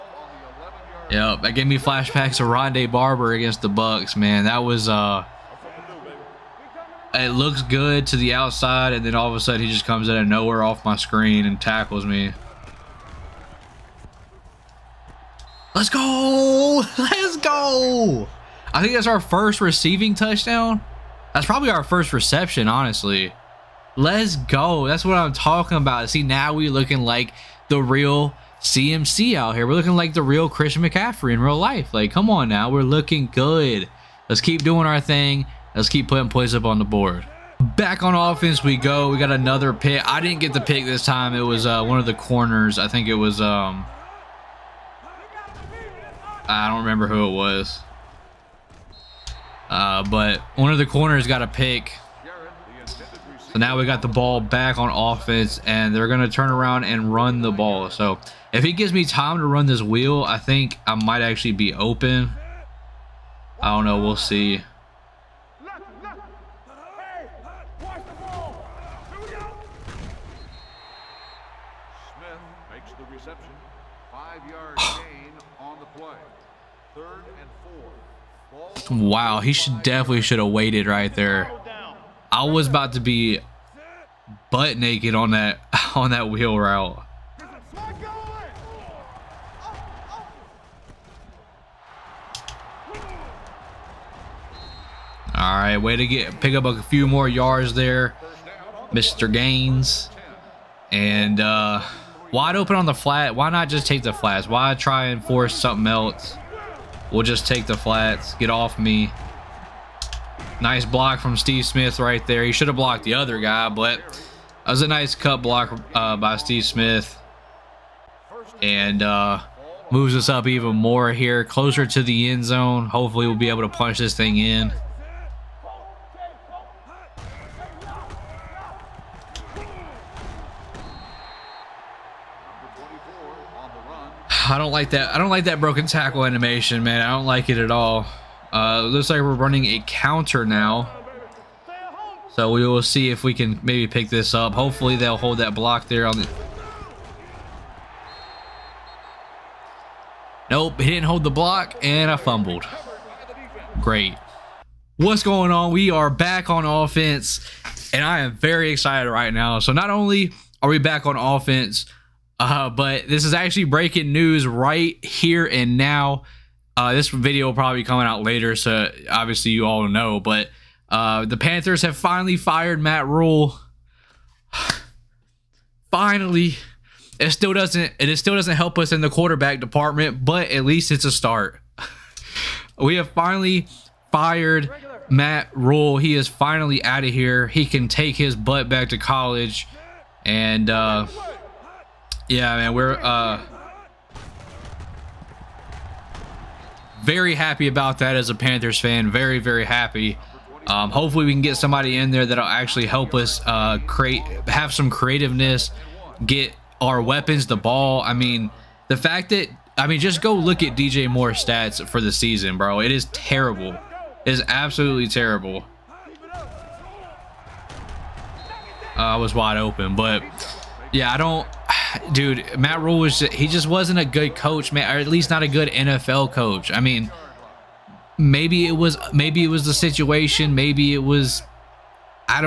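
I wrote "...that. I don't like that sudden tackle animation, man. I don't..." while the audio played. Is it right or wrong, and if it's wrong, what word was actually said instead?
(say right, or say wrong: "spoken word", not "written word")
wrong: "broken", not "sudden".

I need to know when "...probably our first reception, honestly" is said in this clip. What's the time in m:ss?
0:21.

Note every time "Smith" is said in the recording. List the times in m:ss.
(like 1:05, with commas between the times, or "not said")
1:51, 1:56.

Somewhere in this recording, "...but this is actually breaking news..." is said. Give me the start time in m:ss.
2:42.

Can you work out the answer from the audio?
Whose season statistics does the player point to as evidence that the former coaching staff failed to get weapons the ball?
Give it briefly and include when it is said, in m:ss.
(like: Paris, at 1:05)
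DJ Moore, at 3:30.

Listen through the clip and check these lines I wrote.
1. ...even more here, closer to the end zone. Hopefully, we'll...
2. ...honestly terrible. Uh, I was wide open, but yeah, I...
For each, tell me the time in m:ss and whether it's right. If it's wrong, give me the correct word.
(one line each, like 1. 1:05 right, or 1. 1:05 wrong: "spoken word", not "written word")
1. 2:00 right
2. 3:34 wrong: "absolutely", not "honestly".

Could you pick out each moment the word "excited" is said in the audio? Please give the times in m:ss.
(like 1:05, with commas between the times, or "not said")
2:38.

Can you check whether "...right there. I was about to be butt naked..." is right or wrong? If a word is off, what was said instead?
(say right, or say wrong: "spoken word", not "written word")
right.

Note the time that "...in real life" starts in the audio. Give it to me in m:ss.
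0:31.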